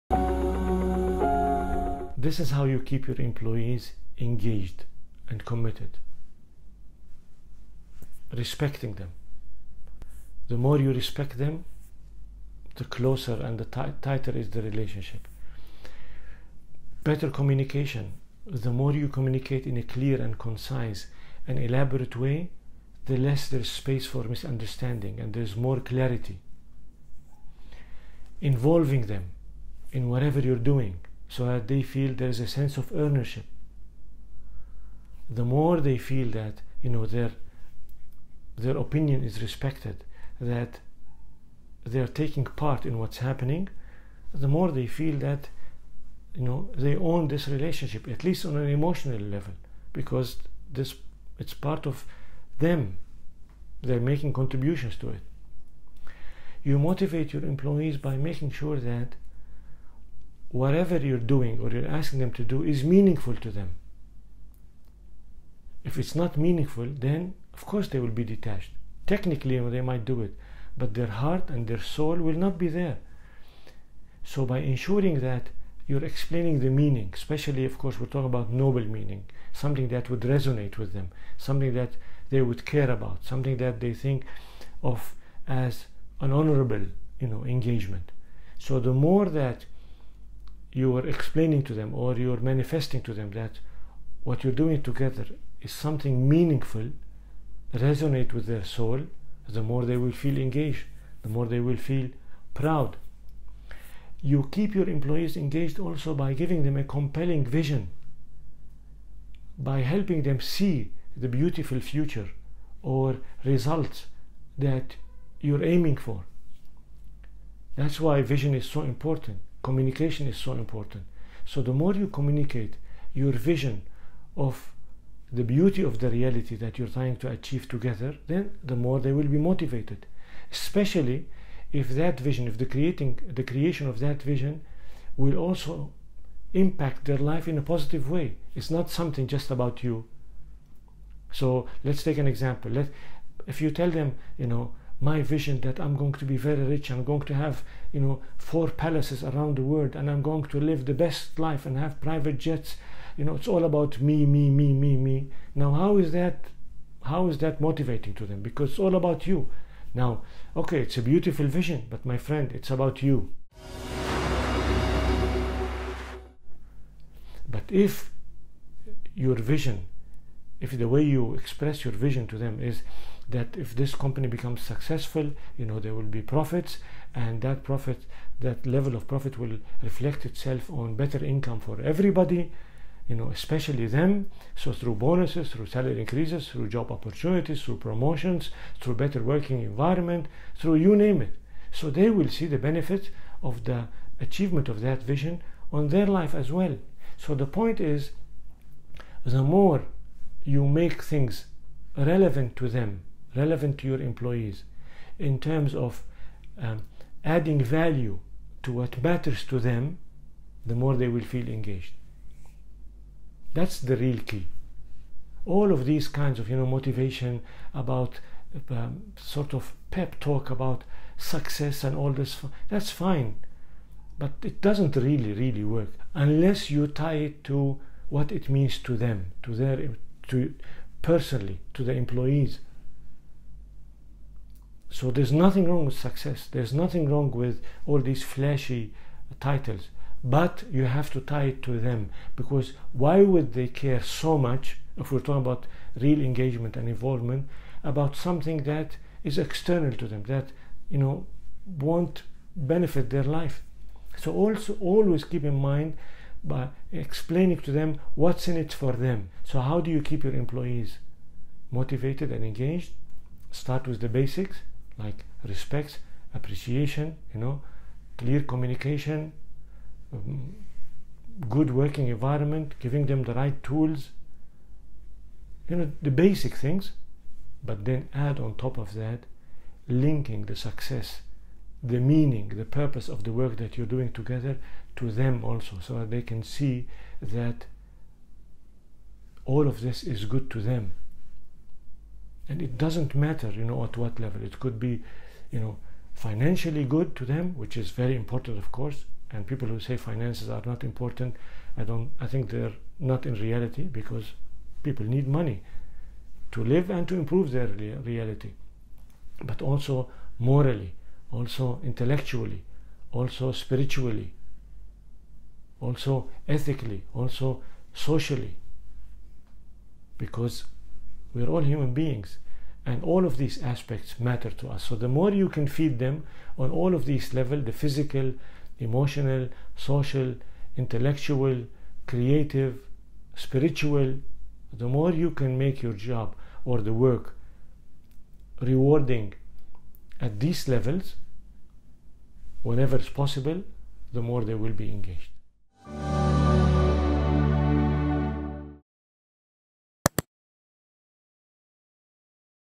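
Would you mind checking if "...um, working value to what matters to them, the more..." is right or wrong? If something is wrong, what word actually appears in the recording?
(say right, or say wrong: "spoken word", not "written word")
wrong: "adding", not "working".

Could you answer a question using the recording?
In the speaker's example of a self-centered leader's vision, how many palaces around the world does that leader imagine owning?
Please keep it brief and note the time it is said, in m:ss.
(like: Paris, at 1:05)
4, at 2:28.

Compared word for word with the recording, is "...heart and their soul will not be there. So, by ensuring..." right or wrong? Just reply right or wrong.
right.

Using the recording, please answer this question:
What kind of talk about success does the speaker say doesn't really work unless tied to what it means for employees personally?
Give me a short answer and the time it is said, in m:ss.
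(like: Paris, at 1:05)
pep talk, at 3:39.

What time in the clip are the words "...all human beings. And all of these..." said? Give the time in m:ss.
5:21.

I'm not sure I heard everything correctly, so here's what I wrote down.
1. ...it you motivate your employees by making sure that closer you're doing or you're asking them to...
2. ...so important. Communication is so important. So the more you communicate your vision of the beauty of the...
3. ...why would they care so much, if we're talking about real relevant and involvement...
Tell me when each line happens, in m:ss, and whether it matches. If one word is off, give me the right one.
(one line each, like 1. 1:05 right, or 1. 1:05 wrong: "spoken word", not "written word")
1. 0:55 wrong: "whatever", not "closer"
2. 1:58 right
3. 4:02 wrong: "engagement", not "relevant".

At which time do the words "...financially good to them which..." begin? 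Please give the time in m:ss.
4:56.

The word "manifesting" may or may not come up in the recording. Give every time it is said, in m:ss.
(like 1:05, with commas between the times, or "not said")
1:32.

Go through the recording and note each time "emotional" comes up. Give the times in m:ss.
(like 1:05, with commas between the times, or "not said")
0:48, 5:28.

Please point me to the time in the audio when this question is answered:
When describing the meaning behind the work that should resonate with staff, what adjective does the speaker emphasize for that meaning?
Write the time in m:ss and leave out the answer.
1:18.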